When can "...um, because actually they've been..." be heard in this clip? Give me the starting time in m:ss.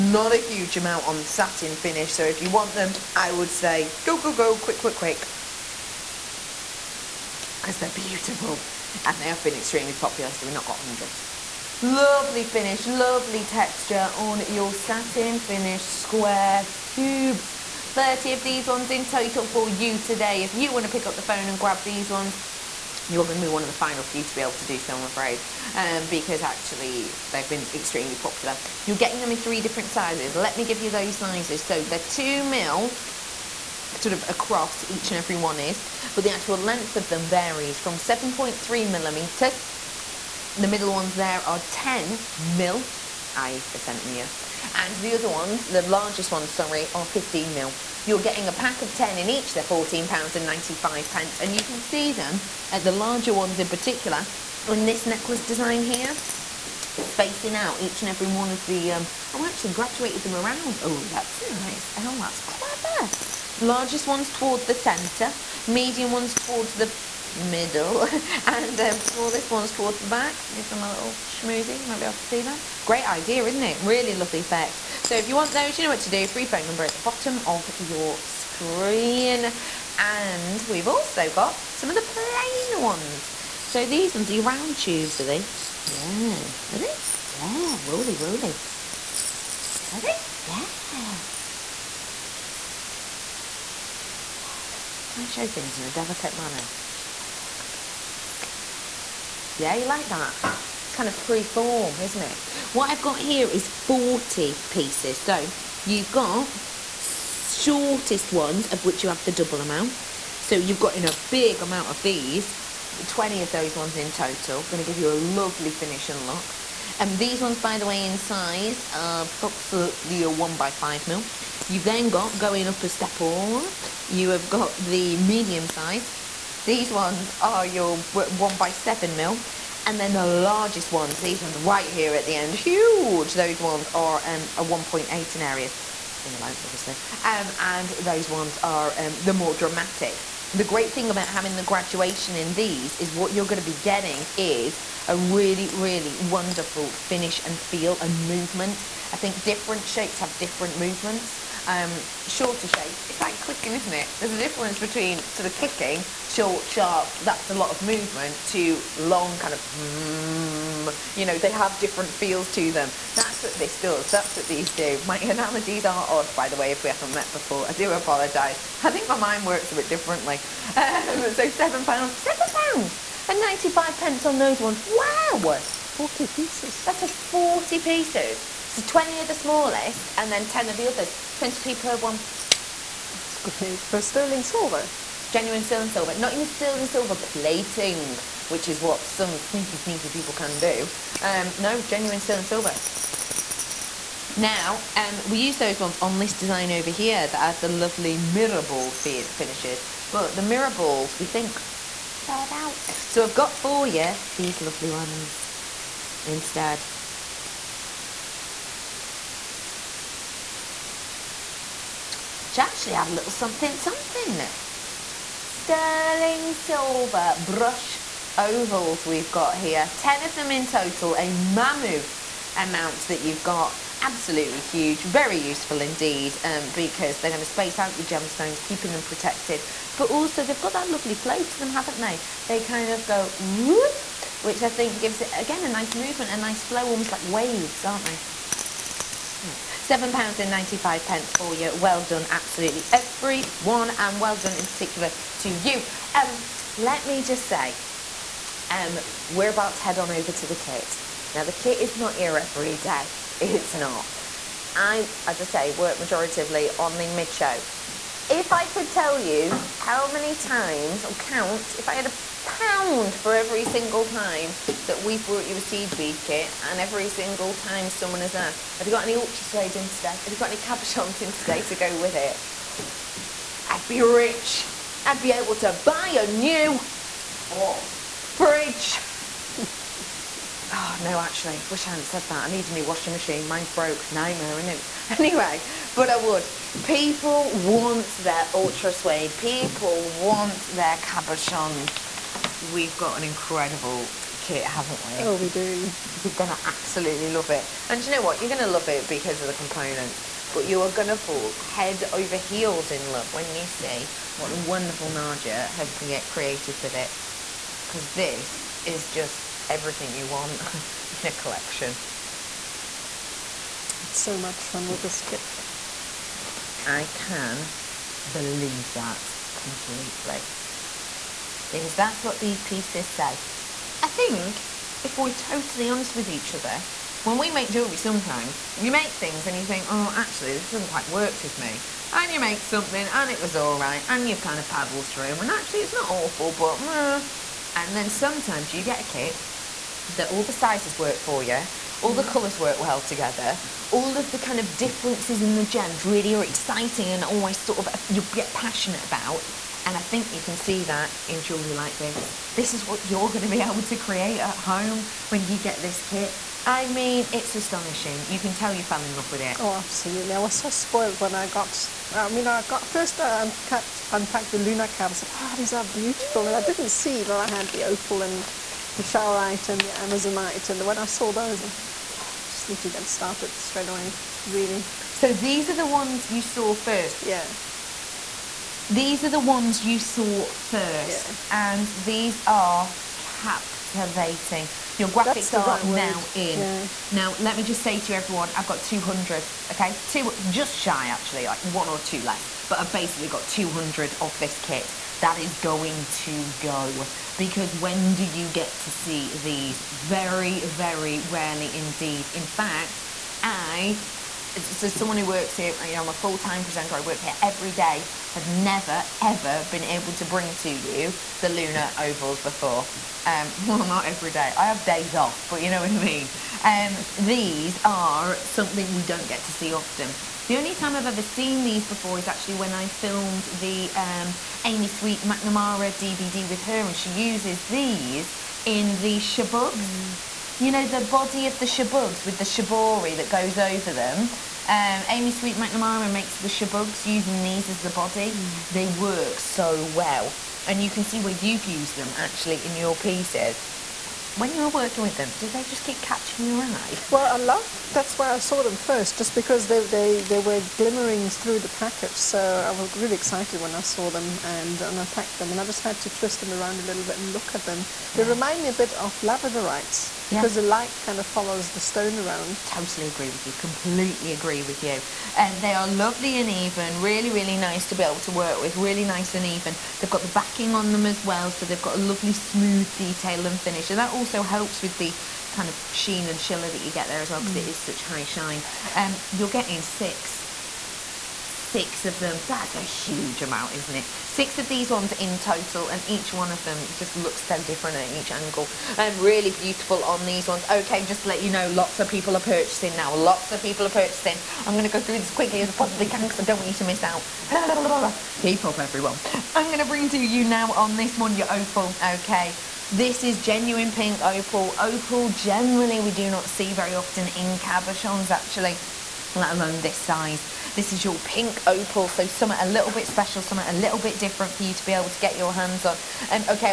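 0:25.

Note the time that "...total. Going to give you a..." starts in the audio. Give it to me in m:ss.
1:54.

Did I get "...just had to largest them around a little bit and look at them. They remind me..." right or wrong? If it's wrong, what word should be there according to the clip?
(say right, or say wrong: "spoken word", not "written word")
wrong: "twist", not "largest".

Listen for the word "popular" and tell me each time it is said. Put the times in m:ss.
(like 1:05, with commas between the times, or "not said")
0:09, 0:28.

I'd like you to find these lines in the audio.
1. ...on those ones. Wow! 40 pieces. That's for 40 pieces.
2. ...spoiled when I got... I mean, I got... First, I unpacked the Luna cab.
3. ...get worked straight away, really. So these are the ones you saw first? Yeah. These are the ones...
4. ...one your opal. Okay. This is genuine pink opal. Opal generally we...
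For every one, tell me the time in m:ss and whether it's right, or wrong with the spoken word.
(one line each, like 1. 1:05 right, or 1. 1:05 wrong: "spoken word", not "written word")
1. 2:54 right
2. 6:00 right
3. 6:12 wrong: "started", not "worked"
4. 8:21 right.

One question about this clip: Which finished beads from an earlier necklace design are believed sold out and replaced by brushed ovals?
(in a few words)
mirror balls.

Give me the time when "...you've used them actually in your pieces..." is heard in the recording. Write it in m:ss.
7:21.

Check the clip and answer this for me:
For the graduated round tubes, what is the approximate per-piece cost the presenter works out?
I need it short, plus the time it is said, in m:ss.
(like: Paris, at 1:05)
20p, at 3:01.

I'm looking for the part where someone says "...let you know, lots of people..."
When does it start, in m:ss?
8:11.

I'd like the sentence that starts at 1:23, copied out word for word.
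So these ones are round tubes, are they?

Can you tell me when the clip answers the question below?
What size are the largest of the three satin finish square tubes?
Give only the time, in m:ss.
0:47.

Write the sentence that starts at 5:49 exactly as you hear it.
And I think you can see that in jewellery like this.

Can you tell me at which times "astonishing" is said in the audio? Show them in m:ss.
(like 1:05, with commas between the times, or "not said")
5:57.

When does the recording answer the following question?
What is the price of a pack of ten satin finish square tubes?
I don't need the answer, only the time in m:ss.
0:49.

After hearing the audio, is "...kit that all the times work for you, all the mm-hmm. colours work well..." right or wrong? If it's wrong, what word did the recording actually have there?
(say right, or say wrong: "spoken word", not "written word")
wrong: "sizes", not "times".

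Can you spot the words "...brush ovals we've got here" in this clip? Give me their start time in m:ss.
3:37.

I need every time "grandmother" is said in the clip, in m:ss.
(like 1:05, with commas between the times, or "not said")
not said.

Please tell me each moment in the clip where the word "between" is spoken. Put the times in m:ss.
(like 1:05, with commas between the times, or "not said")
2:34.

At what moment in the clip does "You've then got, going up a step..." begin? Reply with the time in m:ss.
2:01.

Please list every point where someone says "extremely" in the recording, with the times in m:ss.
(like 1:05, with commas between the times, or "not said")
0:09, 0:27.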